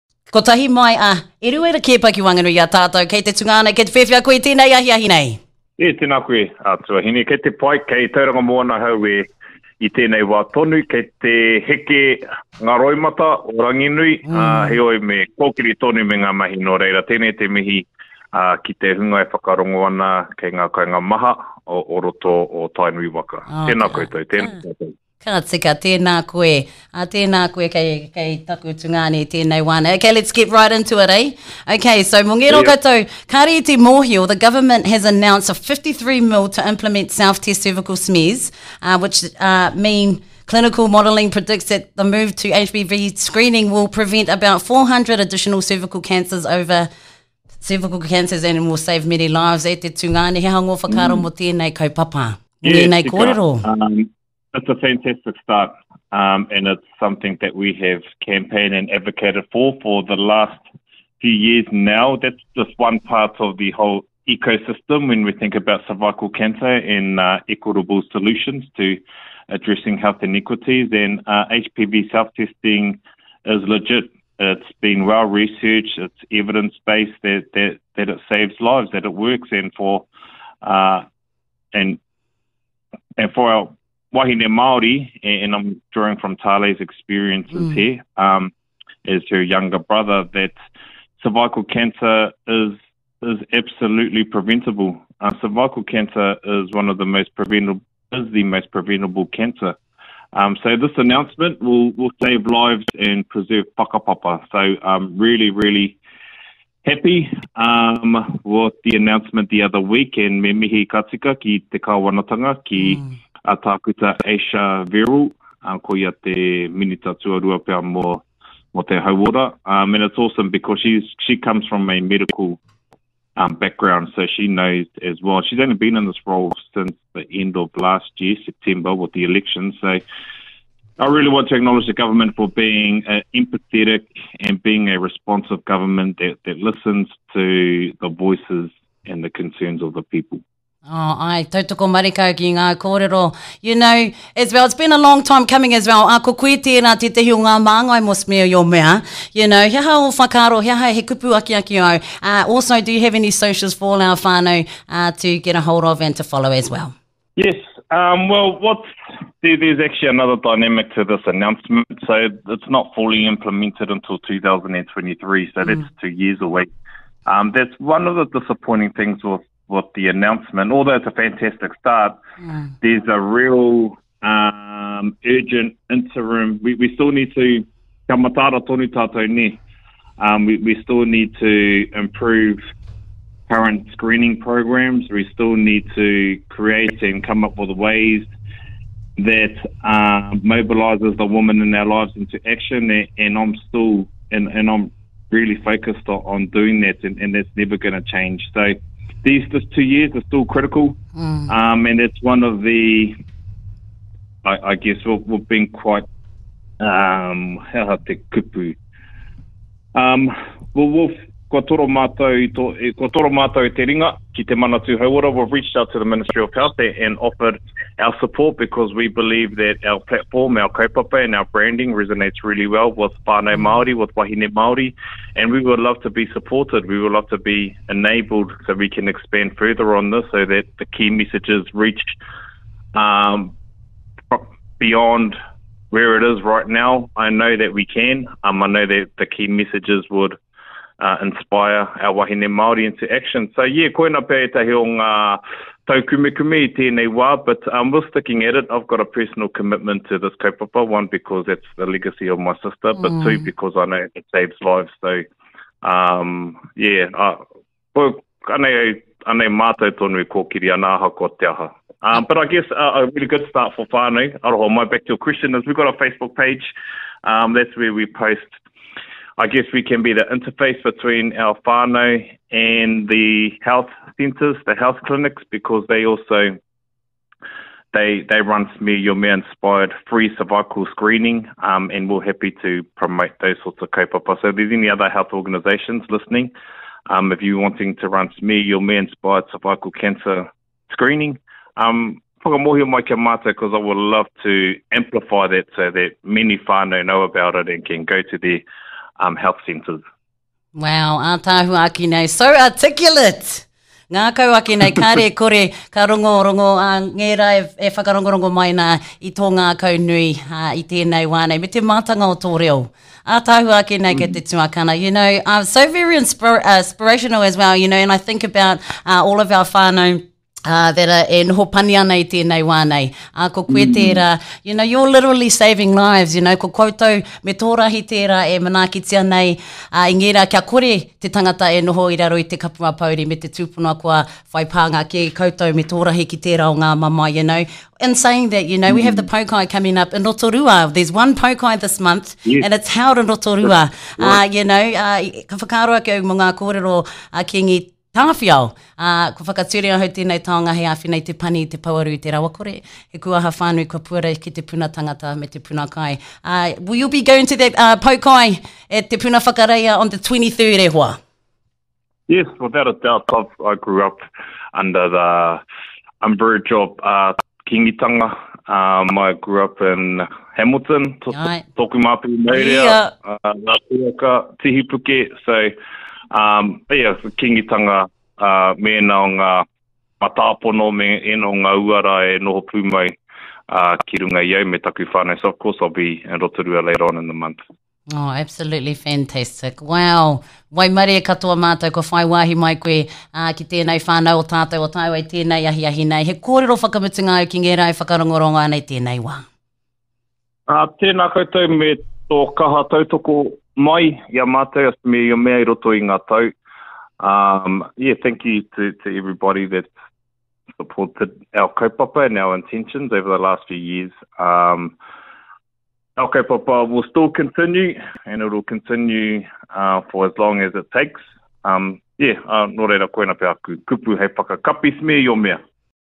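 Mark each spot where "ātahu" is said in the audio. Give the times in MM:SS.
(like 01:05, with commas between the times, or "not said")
05:01, 05:13.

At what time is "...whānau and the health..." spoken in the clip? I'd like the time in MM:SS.
04:31.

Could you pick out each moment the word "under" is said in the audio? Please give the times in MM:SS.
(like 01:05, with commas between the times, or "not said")
06:04.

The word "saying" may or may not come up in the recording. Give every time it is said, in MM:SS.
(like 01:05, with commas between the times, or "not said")
05:38.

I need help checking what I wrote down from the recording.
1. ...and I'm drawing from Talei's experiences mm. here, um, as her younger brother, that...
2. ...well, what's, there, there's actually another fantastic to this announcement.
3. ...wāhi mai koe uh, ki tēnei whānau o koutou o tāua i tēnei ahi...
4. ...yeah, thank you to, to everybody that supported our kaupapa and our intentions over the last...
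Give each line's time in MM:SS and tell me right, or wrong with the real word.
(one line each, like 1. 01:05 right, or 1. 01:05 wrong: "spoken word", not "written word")
1. 01:25 right
2. 02:38 wrong: "dynamic", not "fantastic"
3. 06:32 wrong: "tātou", not "koutou"
4. 06:47 right.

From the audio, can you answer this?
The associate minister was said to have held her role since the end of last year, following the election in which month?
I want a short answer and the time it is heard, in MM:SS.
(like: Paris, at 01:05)
September, at 02:08.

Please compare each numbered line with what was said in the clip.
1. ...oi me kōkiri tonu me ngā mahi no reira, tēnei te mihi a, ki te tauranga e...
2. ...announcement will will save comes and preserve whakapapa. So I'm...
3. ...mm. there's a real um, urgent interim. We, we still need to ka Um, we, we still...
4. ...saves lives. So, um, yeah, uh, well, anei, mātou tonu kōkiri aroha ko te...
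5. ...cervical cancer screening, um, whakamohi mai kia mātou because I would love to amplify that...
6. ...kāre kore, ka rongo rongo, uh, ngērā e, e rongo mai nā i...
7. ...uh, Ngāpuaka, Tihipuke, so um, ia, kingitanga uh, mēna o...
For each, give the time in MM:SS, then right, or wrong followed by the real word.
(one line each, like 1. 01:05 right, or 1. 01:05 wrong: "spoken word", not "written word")
1. 00:14 wrong: "hunga", not "tauranga"
2. 01:40 wrong: "lives", not "comes"
3. 02:52 right
4. 04:14 wrong: "anāha", not "aroha"
5. 04:49 right
6. 05:04 right
7. 06:13 right.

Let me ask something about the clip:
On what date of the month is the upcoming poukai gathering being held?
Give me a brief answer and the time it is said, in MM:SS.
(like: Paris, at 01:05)
23rd, at 06:00.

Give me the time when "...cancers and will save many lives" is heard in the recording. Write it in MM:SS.
00:47.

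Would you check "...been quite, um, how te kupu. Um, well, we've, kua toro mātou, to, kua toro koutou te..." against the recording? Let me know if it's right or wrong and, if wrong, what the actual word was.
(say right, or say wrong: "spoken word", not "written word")
wrong: "mātou", not "koutou".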